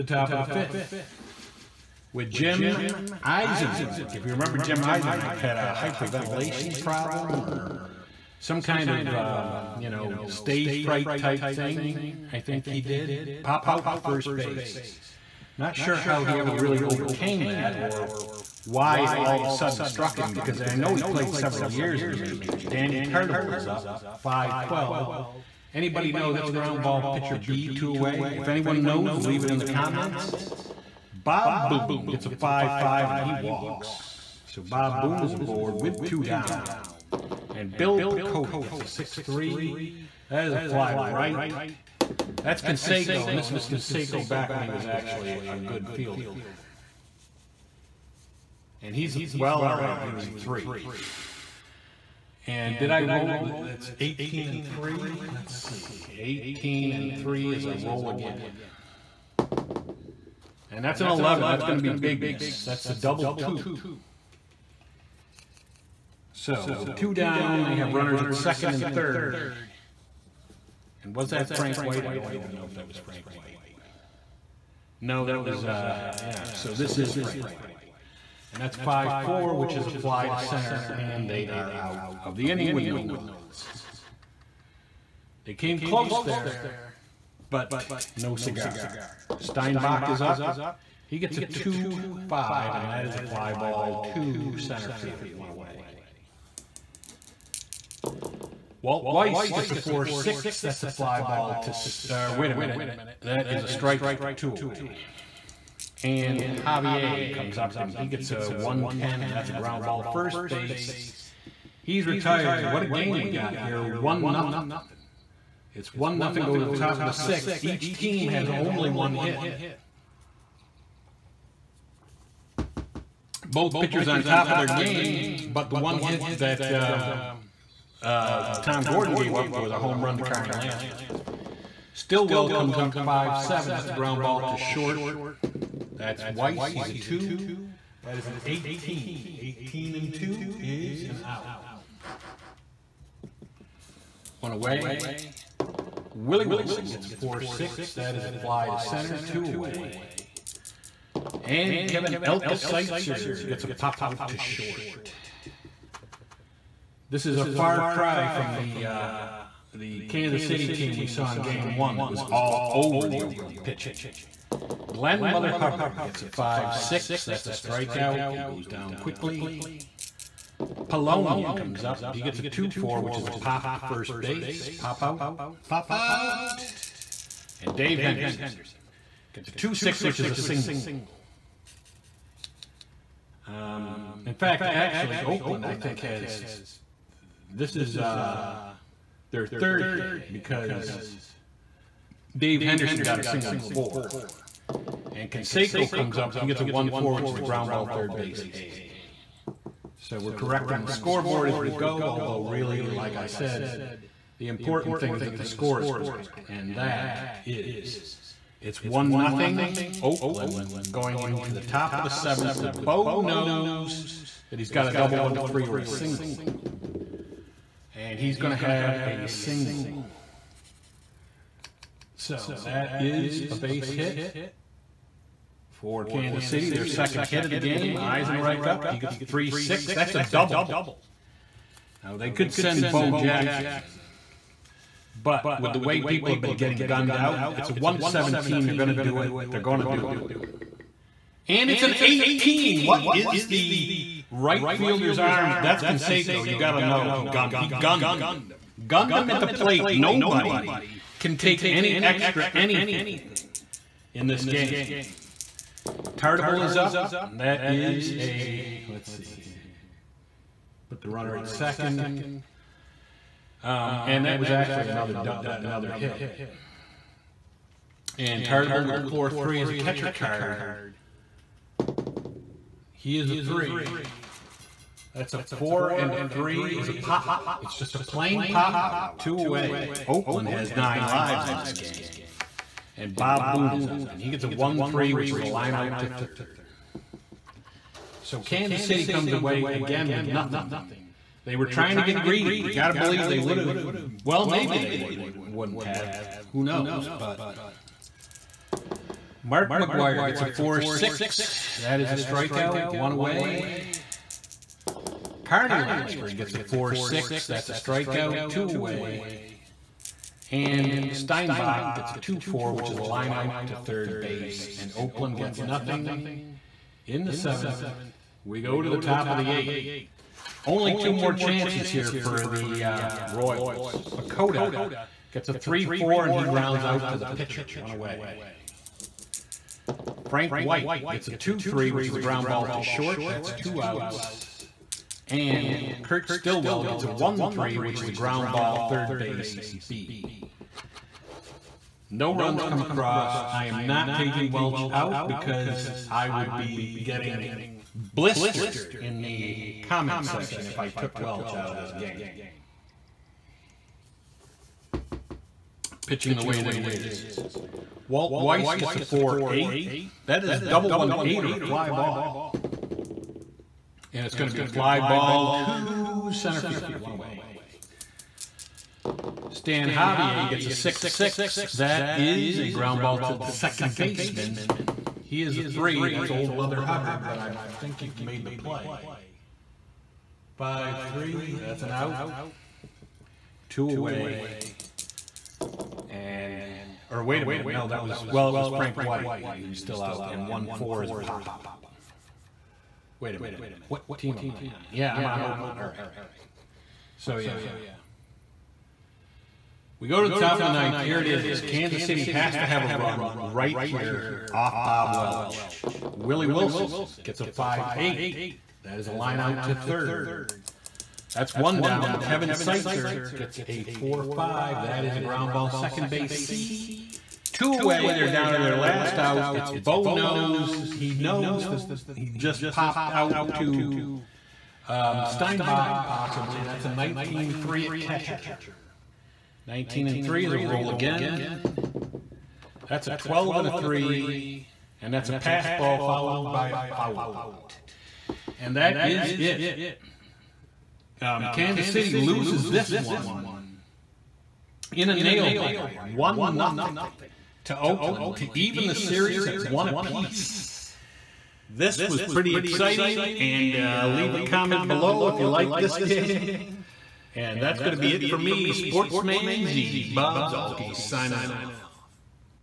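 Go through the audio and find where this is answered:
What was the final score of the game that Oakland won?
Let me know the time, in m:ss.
7:26.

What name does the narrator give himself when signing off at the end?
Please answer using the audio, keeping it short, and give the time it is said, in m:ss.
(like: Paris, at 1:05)
Sportsman Z, at 7:38.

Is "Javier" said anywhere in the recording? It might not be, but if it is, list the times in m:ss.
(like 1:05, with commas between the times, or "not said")
1:46, 6:09.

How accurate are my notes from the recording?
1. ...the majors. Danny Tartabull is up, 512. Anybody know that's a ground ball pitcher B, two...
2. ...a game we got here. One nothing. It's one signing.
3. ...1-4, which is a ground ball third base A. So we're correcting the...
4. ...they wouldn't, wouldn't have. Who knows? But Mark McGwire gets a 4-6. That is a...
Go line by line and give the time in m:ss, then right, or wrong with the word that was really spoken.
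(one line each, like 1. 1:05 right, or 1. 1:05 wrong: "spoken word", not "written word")
1. 0:22 right
2. 1:52 wrong: "nothing", not "signing"
3. 3:16 right
4. 4:54 right.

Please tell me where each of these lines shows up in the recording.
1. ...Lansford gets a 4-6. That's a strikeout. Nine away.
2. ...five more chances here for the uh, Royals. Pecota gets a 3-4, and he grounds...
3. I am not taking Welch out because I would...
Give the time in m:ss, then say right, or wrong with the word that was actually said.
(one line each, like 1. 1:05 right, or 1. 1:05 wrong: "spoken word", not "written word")
1. 5:05 wrong: "Two", not "Nine"
2. 5:20 wrong: "two", not "five"
3. 5:43 right.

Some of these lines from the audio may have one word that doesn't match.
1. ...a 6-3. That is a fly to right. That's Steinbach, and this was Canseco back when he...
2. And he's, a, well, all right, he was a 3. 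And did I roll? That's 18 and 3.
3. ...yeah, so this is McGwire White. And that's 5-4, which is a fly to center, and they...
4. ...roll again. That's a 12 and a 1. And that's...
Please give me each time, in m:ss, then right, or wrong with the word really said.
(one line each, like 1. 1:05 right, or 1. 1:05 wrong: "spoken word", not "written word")
1. 0:38 wrong: "Canseco", not "Steinbach"
2. 0:48 right
3. 1:16 wrong: "Frank", not "McGwire"
4. 7:10 wrong: "3", not "1".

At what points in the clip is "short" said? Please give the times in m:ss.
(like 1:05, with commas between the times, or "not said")
2:14, 2:34, 5:32.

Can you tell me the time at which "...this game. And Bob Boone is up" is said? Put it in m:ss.
4:41.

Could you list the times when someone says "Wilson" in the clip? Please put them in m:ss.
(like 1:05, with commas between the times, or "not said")
2:26, 6:46.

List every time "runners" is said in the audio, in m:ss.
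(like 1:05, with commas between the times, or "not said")
1:07, 4:21.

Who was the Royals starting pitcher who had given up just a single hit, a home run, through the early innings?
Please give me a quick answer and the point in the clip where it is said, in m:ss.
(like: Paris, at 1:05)
Tom Gordon, at 2:08.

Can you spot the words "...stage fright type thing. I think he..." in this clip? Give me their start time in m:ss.
0:10.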